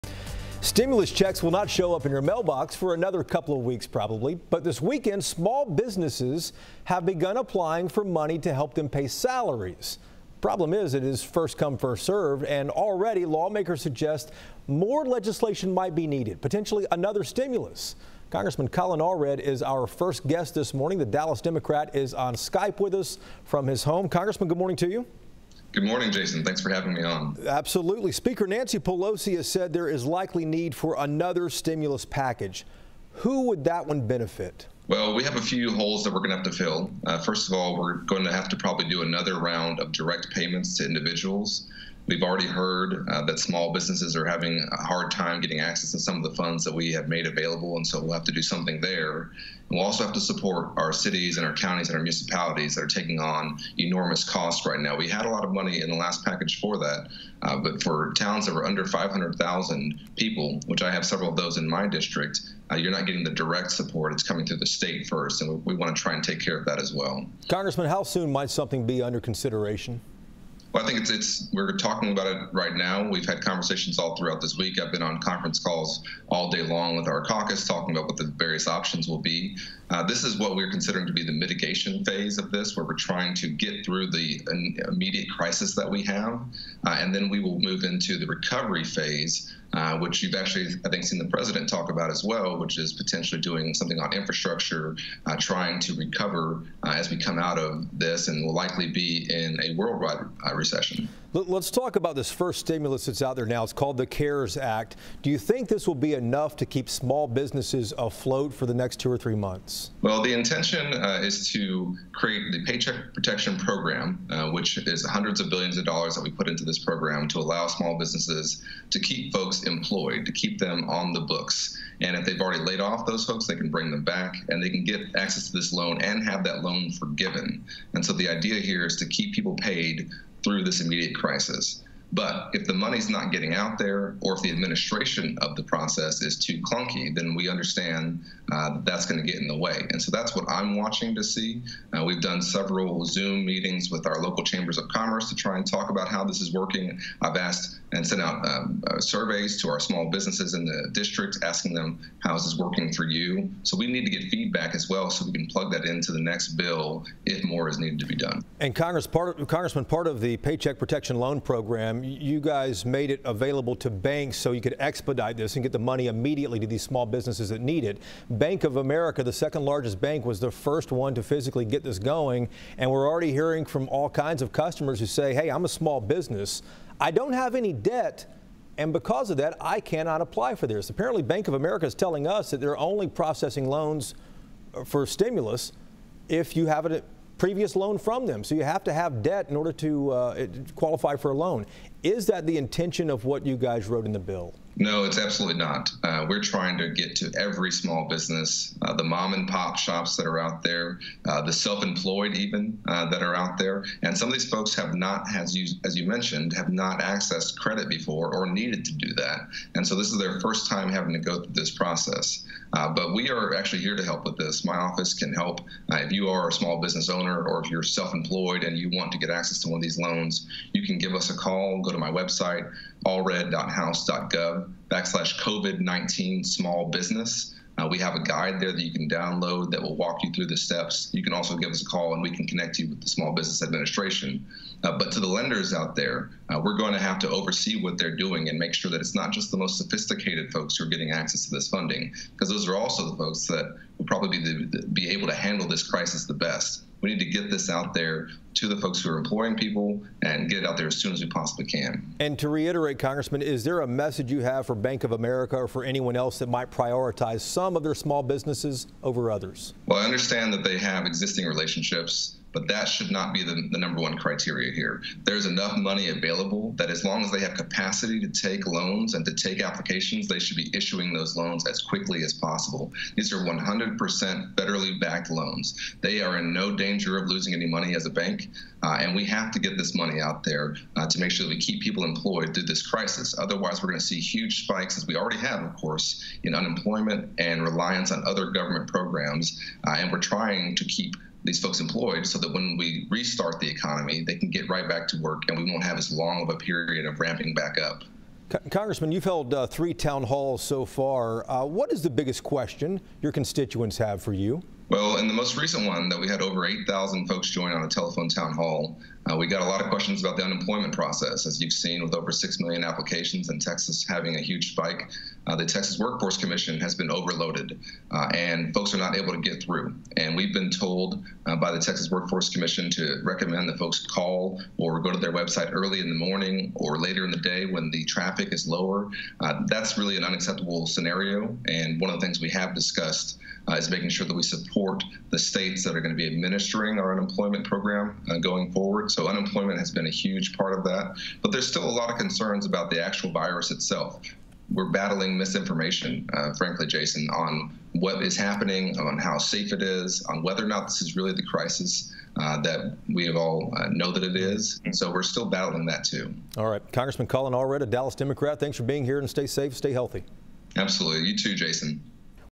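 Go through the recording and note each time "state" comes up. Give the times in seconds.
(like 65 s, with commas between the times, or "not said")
64 s, 335 s.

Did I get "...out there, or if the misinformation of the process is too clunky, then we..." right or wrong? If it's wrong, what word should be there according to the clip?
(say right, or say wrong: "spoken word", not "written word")
wrong: "administration", not "misinformation".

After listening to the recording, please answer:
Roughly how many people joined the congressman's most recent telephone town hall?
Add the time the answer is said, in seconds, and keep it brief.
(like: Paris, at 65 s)
8,000, at 306 s.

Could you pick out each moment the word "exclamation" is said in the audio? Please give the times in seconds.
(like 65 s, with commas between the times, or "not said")
not said.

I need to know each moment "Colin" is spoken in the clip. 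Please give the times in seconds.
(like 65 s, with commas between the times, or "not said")
18 s, 357 s.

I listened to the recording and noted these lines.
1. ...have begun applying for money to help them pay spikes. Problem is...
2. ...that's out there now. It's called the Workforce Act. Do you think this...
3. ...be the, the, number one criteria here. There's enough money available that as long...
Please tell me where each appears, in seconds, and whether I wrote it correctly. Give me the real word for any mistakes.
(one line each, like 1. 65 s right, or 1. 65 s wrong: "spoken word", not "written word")
1. 6 s wrong: "salaries", not "spikes"
2. 103 s wrong: "CARES", not "Workforce"
3. 263 s right.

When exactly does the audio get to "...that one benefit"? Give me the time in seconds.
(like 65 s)
33 s.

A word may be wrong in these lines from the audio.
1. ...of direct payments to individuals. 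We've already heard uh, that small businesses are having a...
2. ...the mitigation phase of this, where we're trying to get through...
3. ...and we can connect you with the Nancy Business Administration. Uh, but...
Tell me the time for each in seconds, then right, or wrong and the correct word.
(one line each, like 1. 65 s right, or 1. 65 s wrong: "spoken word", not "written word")
1. 39 s right
2. 81 s right
3. 232 s wrong: "Small", not "Nancy".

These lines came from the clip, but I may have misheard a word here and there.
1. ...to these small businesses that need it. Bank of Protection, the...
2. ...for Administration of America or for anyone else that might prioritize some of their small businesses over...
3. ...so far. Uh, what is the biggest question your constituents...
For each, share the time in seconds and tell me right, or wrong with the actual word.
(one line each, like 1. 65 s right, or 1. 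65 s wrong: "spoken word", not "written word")
1. 166 s wrong: "America", not "Protection"
2. 254 s wrong: "Bank", not "Administration"
3. 300 s right.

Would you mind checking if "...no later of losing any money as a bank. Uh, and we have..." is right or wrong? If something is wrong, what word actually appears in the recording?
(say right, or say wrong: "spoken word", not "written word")
wrong: "danger", not "later".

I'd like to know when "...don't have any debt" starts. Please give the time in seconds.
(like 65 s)
177 s.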